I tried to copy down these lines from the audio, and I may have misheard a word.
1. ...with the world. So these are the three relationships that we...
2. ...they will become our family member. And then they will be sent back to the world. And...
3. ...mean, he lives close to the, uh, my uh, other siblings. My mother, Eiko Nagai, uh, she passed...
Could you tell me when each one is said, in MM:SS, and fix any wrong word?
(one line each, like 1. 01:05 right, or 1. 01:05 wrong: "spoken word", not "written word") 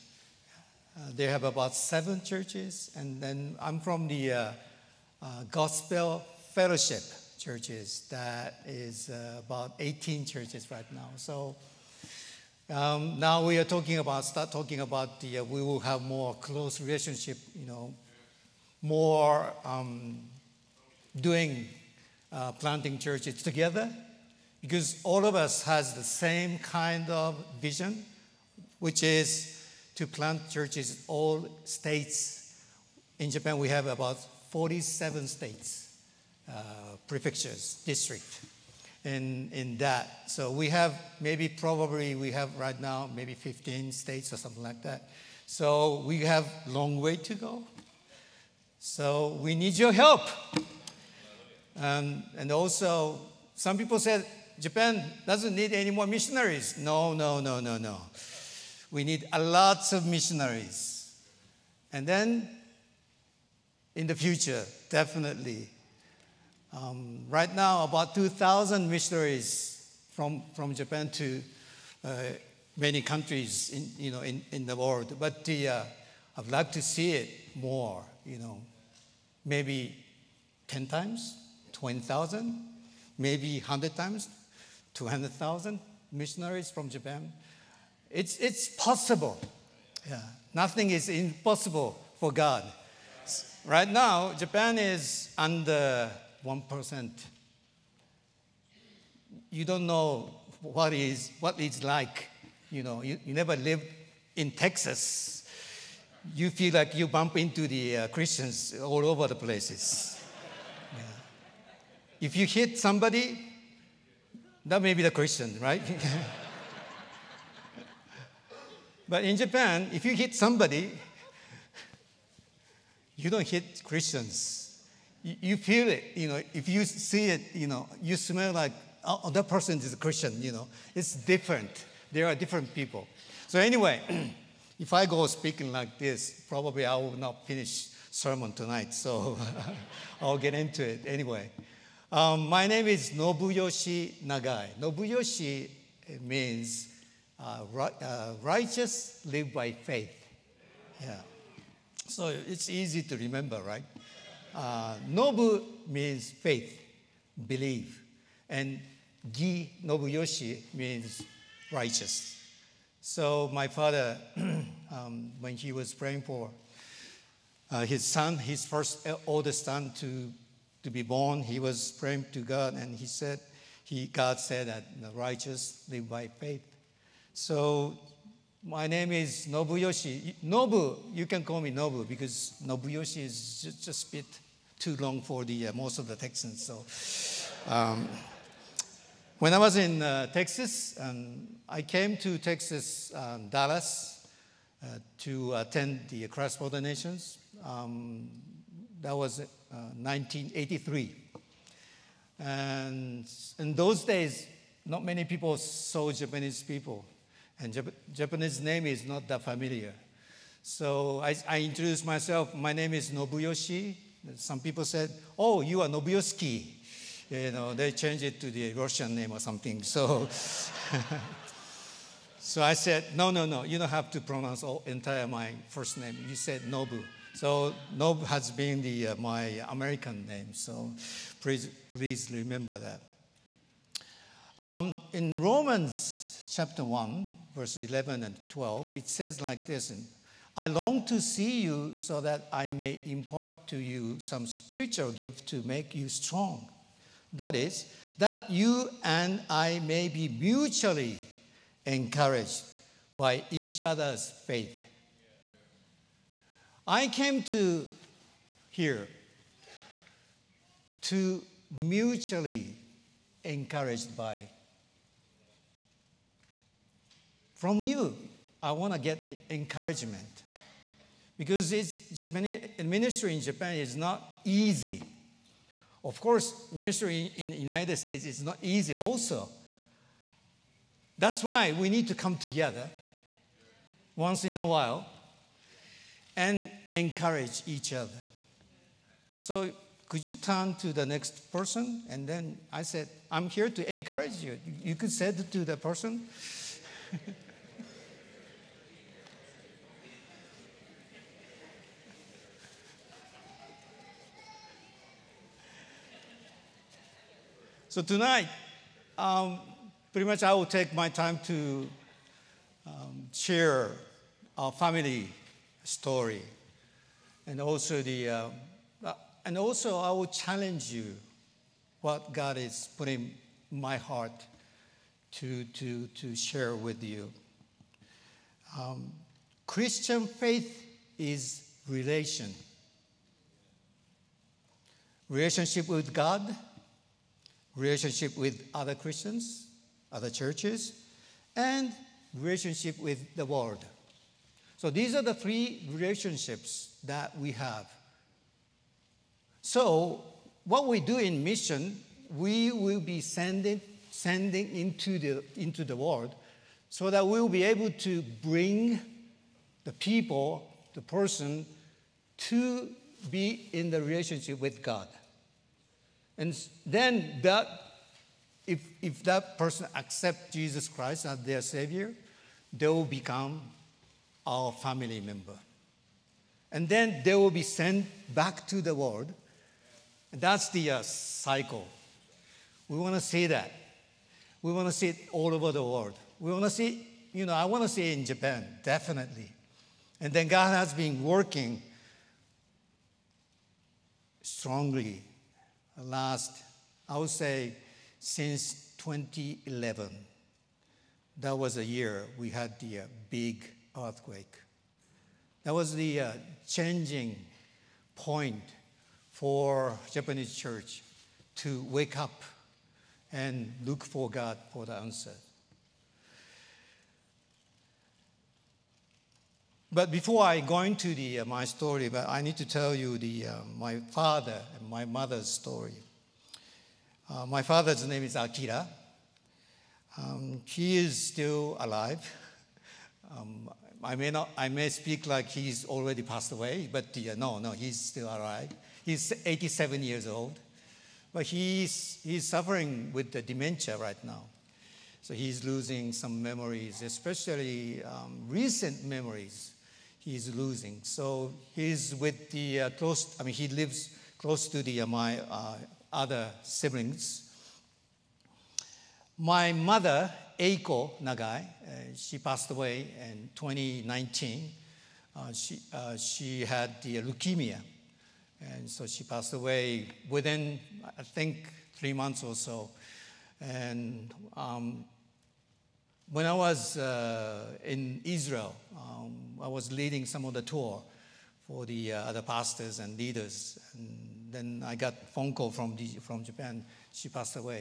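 1. 05:42 right
2. 06:12 right
3. 07:33 right.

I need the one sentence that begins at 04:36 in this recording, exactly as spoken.
Of course, ministry in the United States is not easy also.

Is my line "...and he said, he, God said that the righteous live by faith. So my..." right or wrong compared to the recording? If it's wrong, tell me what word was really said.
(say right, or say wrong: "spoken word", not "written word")
right.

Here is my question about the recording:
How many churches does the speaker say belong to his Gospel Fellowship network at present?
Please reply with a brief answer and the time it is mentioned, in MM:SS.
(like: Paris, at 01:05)
18, at 00:09.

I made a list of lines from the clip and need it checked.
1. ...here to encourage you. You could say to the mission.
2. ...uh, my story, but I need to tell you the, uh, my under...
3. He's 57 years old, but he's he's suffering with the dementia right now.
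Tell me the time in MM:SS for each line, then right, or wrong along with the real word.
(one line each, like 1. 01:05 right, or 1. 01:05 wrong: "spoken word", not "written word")
1. 04:53 wrong: "person", not "mission"
2. 07:01 wrong: "father", not "under"
3. 07:19 wrong: "87", not "57".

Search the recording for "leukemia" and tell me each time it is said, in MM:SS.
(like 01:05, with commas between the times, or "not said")
07:47.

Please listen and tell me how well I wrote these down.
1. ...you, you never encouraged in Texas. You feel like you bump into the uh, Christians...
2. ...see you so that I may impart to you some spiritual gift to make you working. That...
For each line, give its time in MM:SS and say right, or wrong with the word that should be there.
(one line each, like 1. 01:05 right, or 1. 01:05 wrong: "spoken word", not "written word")
1. 01:43 wrong: "lived", not "encouraged"
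2. 04:01 wrong: "strong", not "working".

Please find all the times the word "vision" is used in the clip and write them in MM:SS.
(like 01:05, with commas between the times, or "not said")
00:27.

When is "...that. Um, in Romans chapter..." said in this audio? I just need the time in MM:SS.
03:52.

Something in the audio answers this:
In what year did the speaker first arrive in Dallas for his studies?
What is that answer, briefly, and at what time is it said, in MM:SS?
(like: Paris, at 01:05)
1983, at 03:19.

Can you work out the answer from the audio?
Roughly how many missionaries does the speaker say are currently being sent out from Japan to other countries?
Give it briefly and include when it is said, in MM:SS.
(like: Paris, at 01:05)
2,000, at 01:08.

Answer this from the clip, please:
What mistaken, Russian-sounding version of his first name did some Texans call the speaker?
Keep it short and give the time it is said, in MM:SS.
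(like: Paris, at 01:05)
Nobiosky, at 03:35.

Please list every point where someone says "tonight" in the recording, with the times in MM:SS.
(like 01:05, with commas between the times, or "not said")
02:18, 05:08.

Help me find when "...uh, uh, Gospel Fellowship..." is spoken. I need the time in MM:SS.
00:04.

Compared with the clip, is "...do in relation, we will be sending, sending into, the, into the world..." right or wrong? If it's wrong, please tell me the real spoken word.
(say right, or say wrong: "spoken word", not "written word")
wrong: "mission", not "relation".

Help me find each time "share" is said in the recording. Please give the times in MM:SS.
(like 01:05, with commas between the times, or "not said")
05:13, 05:26.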